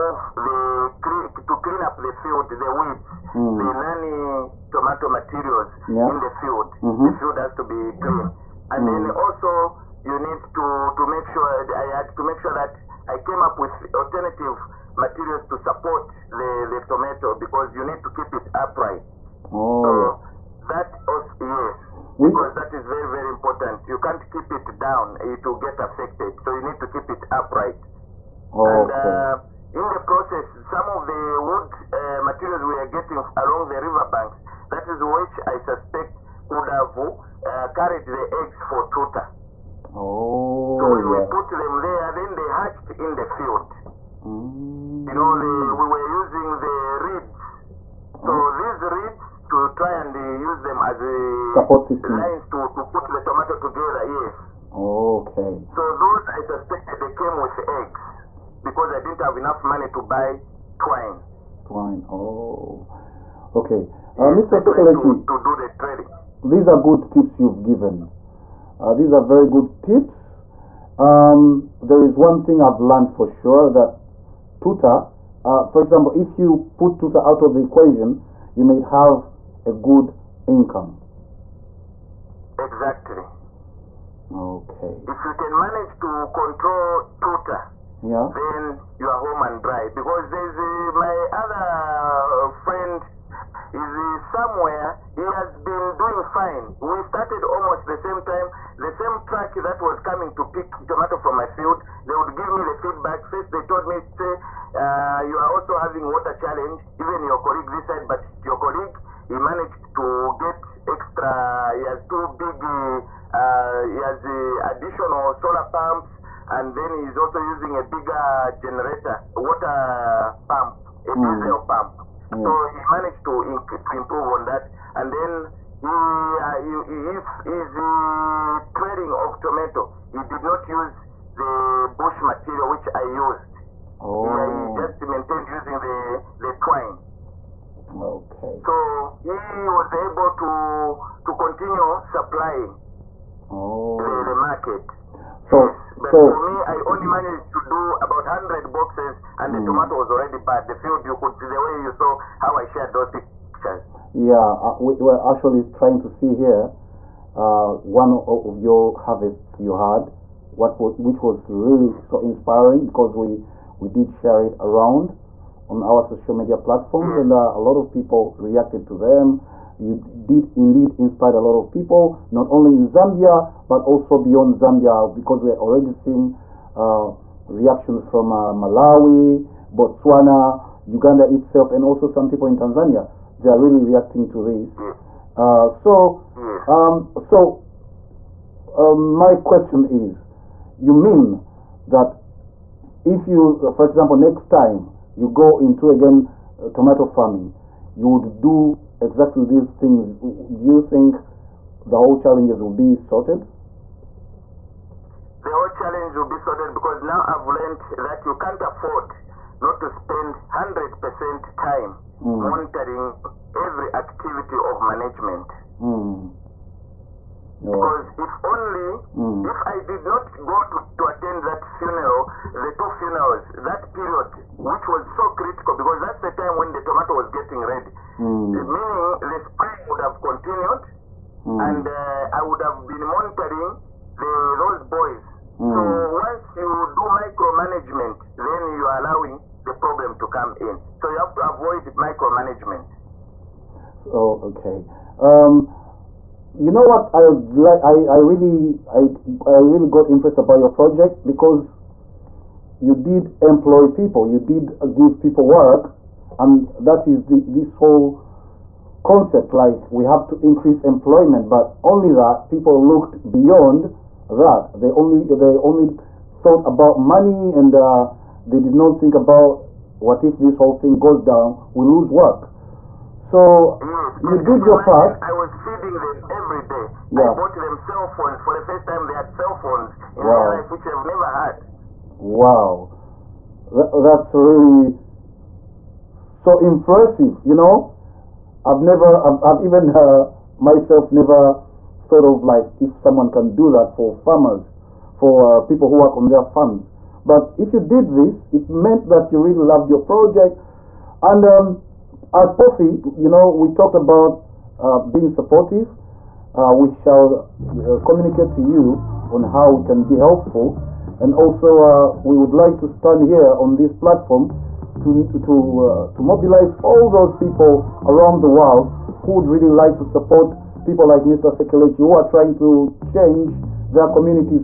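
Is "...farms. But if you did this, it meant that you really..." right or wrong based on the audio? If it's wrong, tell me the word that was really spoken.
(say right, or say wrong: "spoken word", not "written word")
right.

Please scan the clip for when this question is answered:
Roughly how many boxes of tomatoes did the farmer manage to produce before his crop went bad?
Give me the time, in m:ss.
2:28.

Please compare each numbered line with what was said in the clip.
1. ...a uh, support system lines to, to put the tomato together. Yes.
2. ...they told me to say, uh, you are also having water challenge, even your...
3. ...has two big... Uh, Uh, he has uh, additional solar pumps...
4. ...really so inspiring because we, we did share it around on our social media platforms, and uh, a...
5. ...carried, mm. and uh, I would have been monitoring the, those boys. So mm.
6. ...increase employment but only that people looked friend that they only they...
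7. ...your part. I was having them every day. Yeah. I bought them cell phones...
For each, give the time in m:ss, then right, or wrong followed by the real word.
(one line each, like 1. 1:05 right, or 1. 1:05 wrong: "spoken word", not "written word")
1. 0:50 right
2. 1:43 right
3. 1:51 right
4. 2:41 right
5. 3:50 wrong: "continued", not "carried"
6. 4:20 wrong: "beyond", not "friend"
7. 4:34 wrong: "feeding", not "having".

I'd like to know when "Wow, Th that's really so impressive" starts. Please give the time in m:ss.
4:42.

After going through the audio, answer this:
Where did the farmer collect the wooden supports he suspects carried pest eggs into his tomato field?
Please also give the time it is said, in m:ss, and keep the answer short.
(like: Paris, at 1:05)
Along the riverbanks, at 0:33.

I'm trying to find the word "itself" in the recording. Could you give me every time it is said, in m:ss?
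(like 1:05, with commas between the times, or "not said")
3:01.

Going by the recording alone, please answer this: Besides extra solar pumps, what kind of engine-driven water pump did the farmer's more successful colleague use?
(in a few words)
Diesel pump.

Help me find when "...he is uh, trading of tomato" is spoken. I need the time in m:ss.
2:06.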